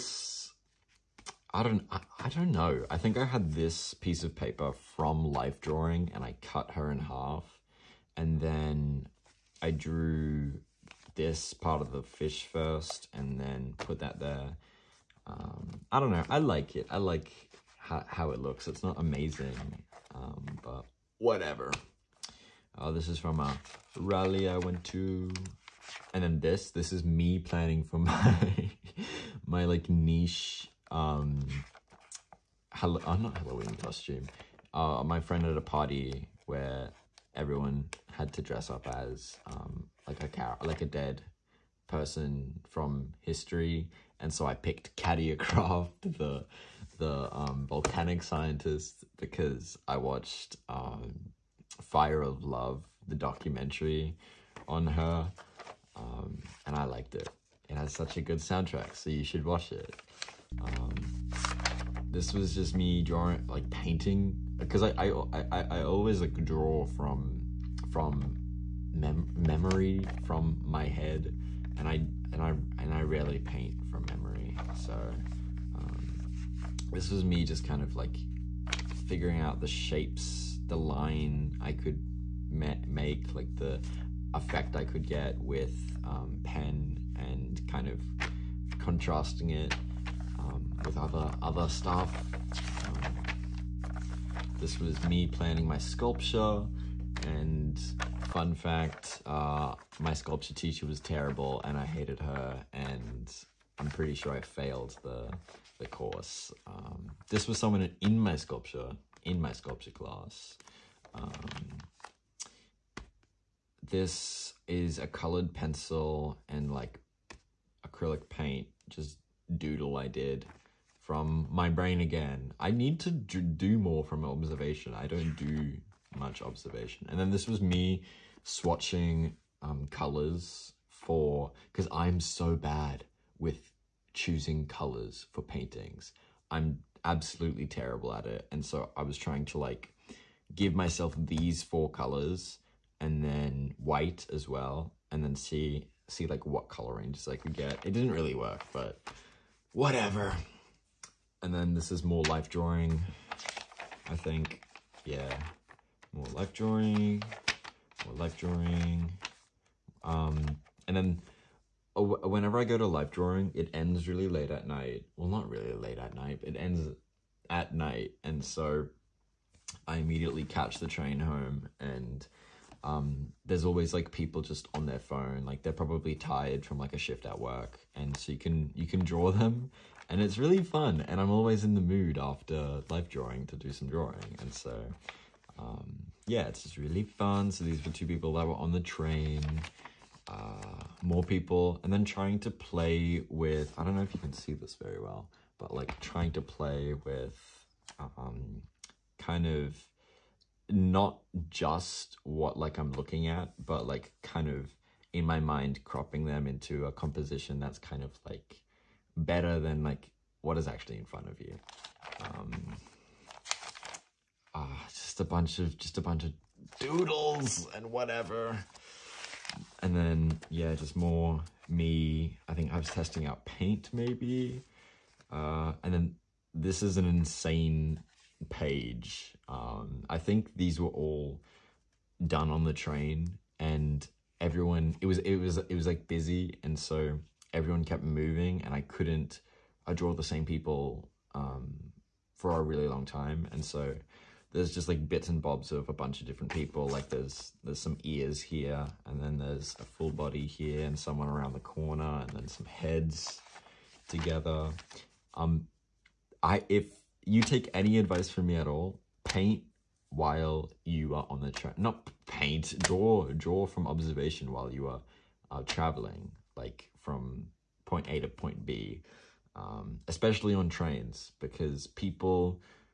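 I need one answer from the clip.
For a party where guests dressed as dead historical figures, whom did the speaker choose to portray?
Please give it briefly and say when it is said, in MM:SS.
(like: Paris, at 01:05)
Katia, at 00:44.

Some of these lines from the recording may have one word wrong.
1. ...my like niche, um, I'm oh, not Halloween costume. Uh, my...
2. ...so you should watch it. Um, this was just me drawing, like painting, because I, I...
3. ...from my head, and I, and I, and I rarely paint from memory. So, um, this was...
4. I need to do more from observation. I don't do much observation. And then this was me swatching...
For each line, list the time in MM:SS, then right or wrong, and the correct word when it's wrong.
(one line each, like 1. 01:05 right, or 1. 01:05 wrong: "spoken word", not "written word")
1. 00:29 right
2. 00:58 right
3. 01:10 right
4. 02:02 right.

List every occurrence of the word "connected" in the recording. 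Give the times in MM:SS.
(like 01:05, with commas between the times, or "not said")
not said.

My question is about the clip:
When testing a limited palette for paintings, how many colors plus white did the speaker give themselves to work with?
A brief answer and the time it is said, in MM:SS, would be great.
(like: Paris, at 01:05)
4, at 02:21.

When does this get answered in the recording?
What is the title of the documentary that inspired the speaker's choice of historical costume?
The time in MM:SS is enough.
00:51.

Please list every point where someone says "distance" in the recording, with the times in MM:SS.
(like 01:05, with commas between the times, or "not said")
not said.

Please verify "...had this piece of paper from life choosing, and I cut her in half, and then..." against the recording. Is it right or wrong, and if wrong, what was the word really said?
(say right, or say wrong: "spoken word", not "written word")
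wrong: "drawing", not "choosing".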